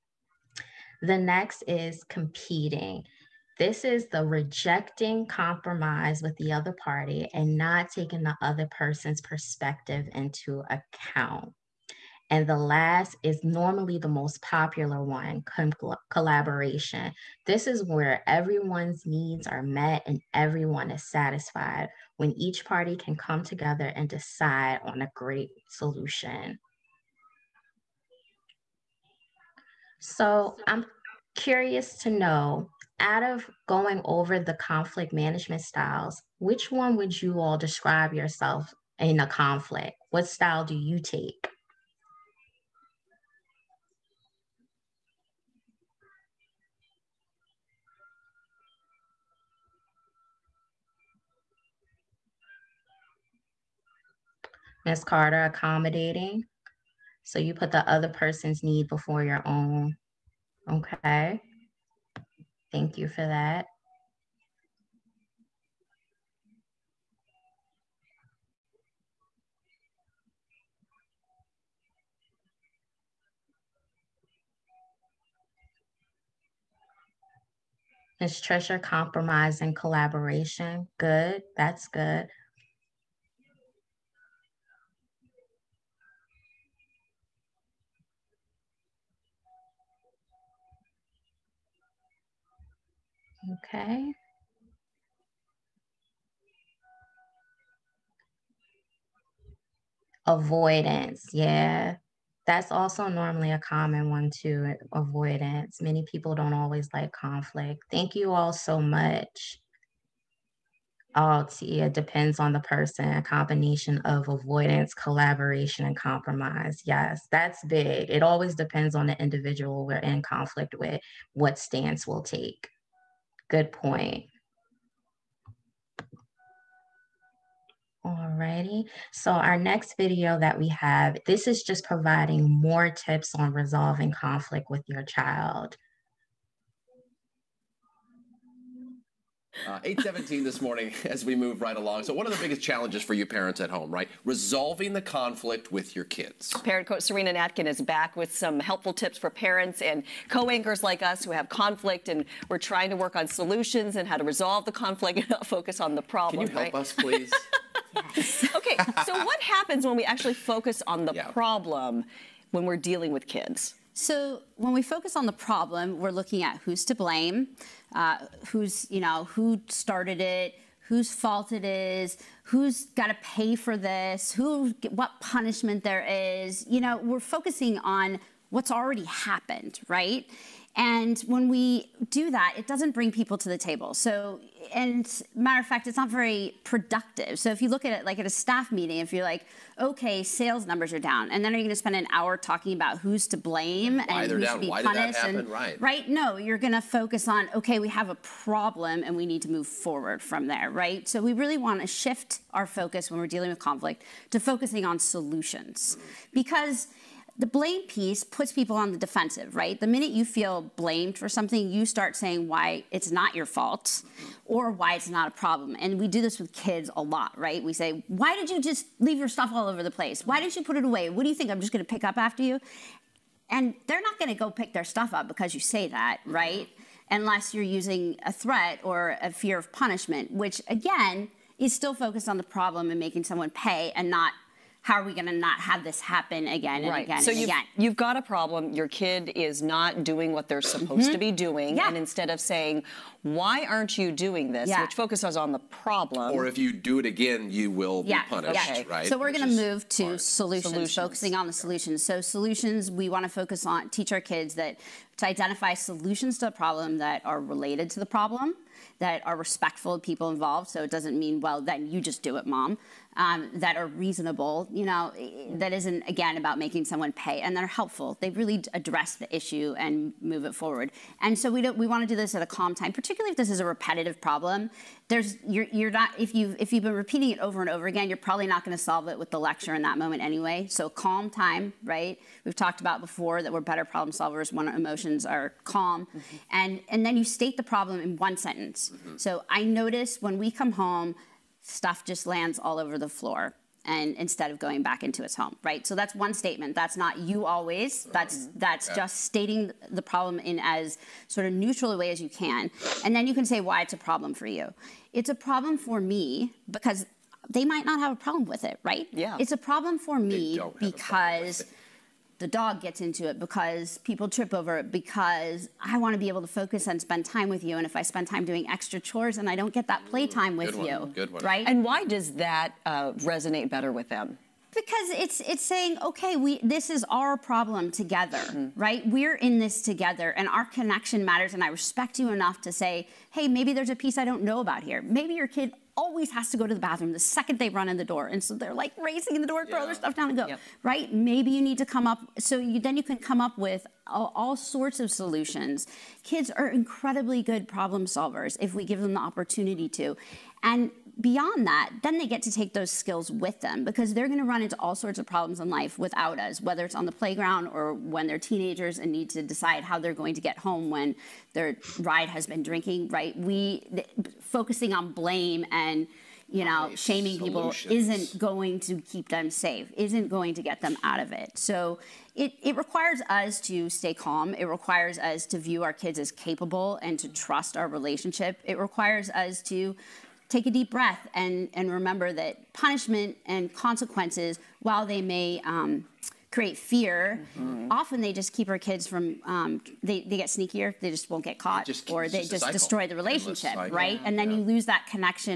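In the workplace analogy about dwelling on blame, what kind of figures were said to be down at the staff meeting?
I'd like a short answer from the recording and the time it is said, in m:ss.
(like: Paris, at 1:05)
Sales numbers, at 3:10.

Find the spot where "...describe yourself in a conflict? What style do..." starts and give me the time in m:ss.
0:37.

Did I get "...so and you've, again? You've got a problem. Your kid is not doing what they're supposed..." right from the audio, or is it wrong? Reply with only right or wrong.
right.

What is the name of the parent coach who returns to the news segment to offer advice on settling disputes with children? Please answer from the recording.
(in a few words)
Sarina Natkin.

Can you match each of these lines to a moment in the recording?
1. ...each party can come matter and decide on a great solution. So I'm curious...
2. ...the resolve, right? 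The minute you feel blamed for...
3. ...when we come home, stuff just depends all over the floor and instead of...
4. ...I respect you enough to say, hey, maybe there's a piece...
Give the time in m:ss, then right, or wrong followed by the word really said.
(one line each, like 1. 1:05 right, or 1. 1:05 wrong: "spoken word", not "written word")
1. 0:22 wrong: "together", not "matter"
2. 3:28 wrong: "defensive", not "resolve"
3. 4:50 wrong: "lands", not "depends"
4. 5:31 right.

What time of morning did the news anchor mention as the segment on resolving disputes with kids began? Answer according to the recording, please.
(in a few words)
8:17.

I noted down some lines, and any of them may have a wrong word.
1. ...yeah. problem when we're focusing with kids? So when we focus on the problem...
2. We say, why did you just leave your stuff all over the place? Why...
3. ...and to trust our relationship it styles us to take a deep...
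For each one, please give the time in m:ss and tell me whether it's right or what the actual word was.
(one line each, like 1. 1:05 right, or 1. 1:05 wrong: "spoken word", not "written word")
1. 2:41 wrong: "dealing", not "focusing"
2. 3:37 right
3. 6:17 wrong: "requires", not "styles".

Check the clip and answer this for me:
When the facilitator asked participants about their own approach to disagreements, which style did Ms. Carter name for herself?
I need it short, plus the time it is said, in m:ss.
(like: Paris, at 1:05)
Accommodating, at 0:55.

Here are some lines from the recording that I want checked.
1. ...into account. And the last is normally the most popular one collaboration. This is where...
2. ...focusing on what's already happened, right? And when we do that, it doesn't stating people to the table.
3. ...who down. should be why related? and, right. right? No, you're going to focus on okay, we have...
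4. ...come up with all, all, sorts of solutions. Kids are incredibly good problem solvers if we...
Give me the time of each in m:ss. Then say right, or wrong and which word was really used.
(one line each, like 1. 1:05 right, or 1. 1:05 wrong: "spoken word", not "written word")
1. 0:10 right
2. 2:57 wrong: "bring", not "stating"
3. 3:14 wrong: "punished", not "related"
4. 5:43 right.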